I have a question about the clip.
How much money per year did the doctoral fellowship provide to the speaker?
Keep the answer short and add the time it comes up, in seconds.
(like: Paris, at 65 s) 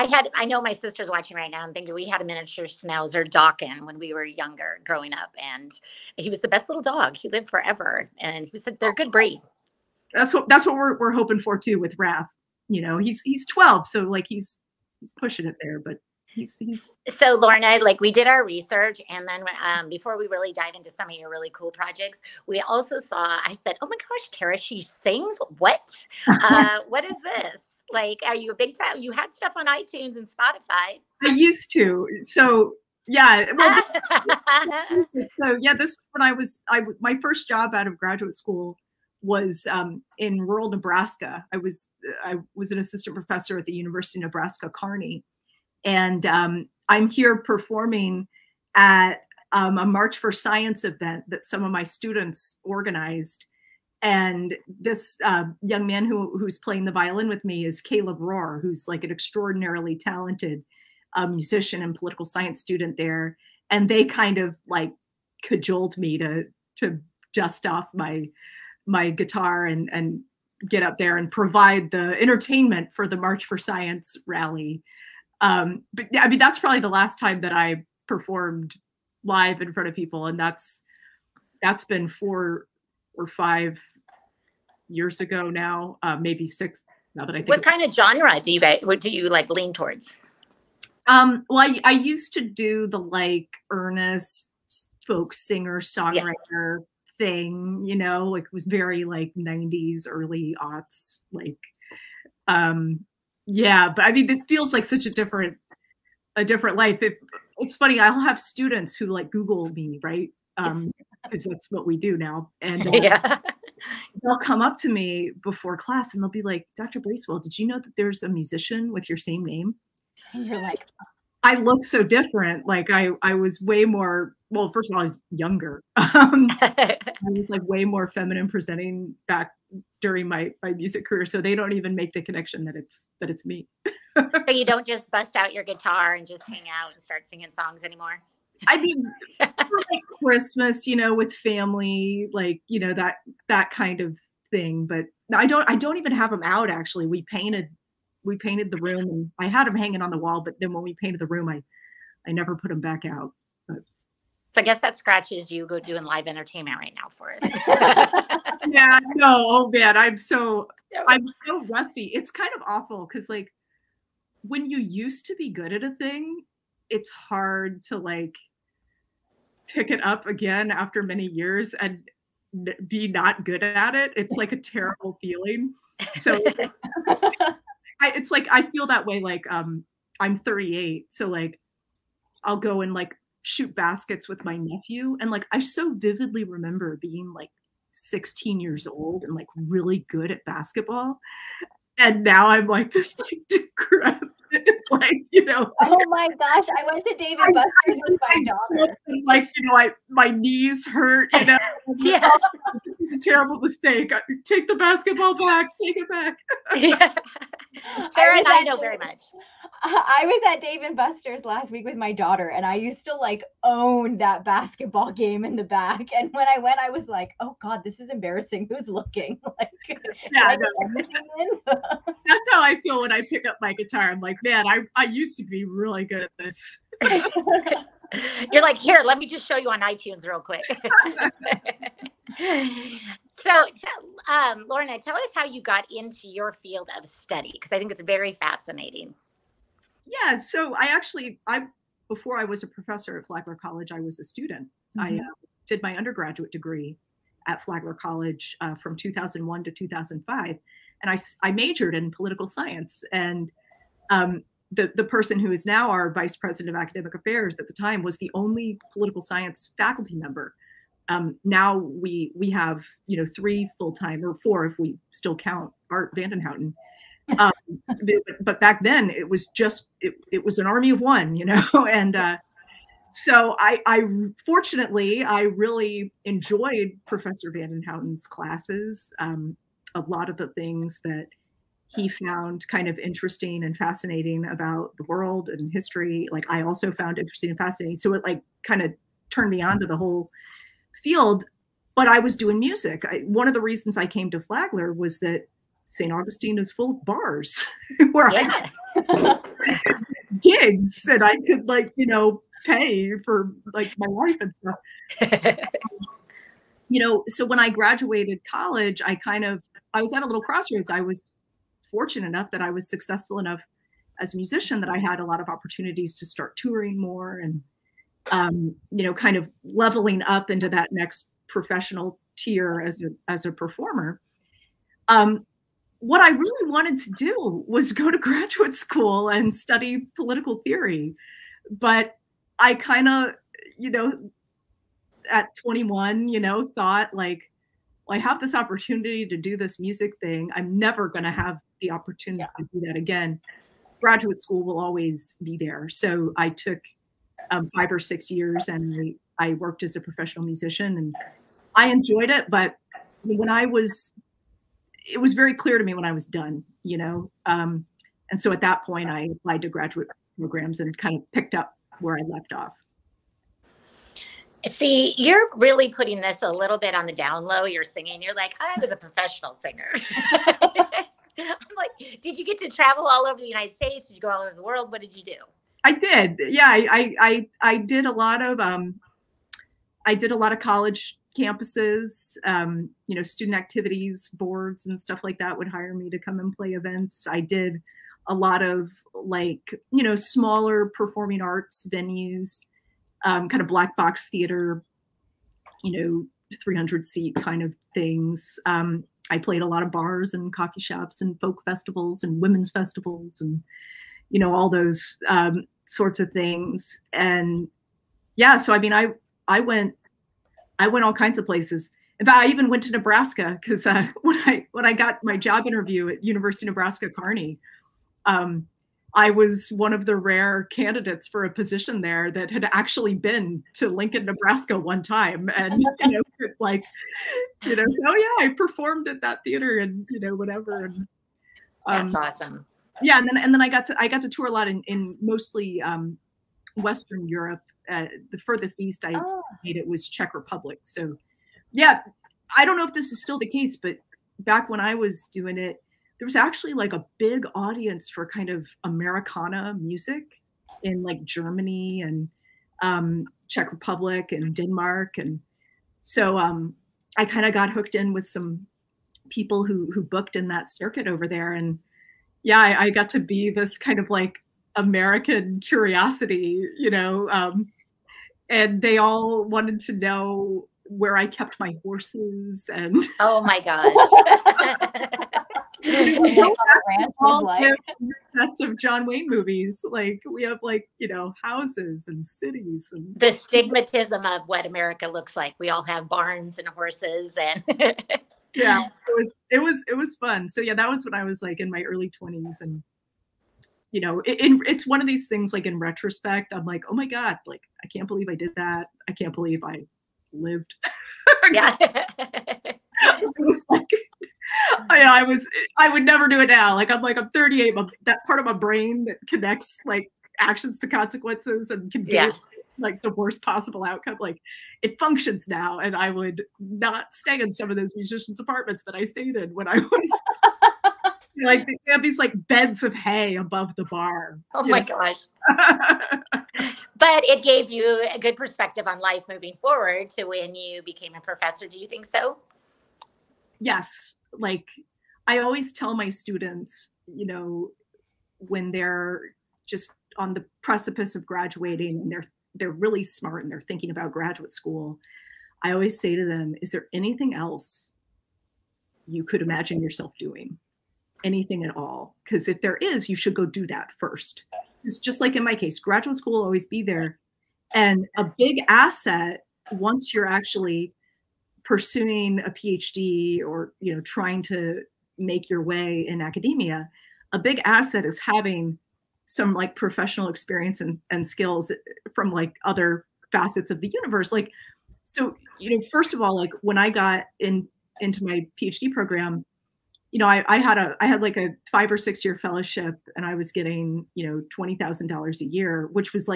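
$20,000, at 584 s.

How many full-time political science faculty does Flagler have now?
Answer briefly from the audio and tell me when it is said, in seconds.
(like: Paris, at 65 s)
3, at 263 s.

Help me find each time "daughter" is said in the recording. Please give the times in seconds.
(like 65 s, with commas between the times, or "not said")
198 s, 212 s.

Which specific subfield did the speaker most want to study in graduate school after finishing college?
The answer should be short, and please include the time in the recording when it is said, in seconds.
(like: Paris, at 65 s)
political theory, at 330 s.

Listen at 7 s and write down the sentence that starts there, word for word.
He lived forever, and he said they're a good breed.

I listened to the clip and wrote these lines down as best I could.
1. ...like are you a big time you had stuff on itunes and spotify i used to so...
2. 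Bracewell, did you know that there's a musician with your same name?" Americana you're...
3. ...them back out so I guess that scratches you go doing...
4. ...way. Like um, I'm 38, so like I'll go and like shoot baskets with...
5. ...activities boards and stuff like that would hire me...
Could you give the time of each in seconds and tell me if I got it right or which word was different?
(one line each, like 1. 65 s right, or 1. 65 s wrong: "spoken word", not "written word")
1. 27 s right
2. 117 s wrong: "And", not "Americana"
3. 152 s right
4. 179 s right
5. 383 s right.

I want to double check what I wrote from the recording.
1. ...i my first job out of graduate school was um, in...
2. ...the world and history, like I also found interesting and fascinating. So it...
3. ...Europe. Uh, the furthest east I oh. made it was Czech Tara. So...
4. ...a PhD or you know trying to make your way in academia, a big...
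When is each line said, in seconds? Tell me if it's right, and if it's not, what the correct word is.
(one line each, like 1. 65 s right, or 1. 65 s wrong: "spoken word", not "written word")
1. 36 s right
2. 284 s right
3. 437 s wrong: "Republic", not "Tara"
4. 562 s right.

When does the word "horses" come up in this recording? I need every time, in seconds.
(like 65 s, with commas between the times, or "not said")
471 s, 486 s.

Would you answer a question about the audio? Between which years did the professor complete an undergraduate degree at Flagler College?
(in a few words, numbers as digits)
2001 to 2005.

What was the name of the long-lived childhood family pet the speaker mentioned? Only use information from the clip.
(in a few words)
Dawkin.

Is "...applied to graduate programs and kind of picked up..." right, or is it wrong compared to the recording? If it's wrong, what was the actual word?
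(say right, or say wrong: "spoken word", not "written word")
right.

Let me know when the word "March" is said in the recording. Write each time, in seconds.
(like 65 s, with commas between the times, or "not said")
49 s, 73 s.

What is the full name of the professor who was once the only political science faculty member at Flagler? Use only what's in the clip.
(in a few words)
Art Vandenhouten.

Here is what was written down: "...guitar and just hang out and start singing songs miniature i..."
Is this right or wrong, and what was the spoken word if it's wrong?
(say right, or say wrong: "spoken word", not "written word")
wrong: "anymore", not "miniature".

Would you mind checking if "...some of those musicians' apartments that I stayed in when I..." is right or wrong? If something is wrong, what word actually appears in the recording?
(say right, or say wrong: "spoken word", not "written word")
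right.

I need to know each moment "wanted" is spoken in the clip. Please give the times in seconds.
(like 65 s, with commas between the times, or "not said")
326 s, 469 s.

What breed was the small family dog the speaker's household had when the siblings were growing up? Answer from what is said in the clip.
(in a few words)
miniature schnauzer.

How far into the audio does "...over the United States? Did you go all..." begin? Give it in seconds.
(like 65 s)
373 s.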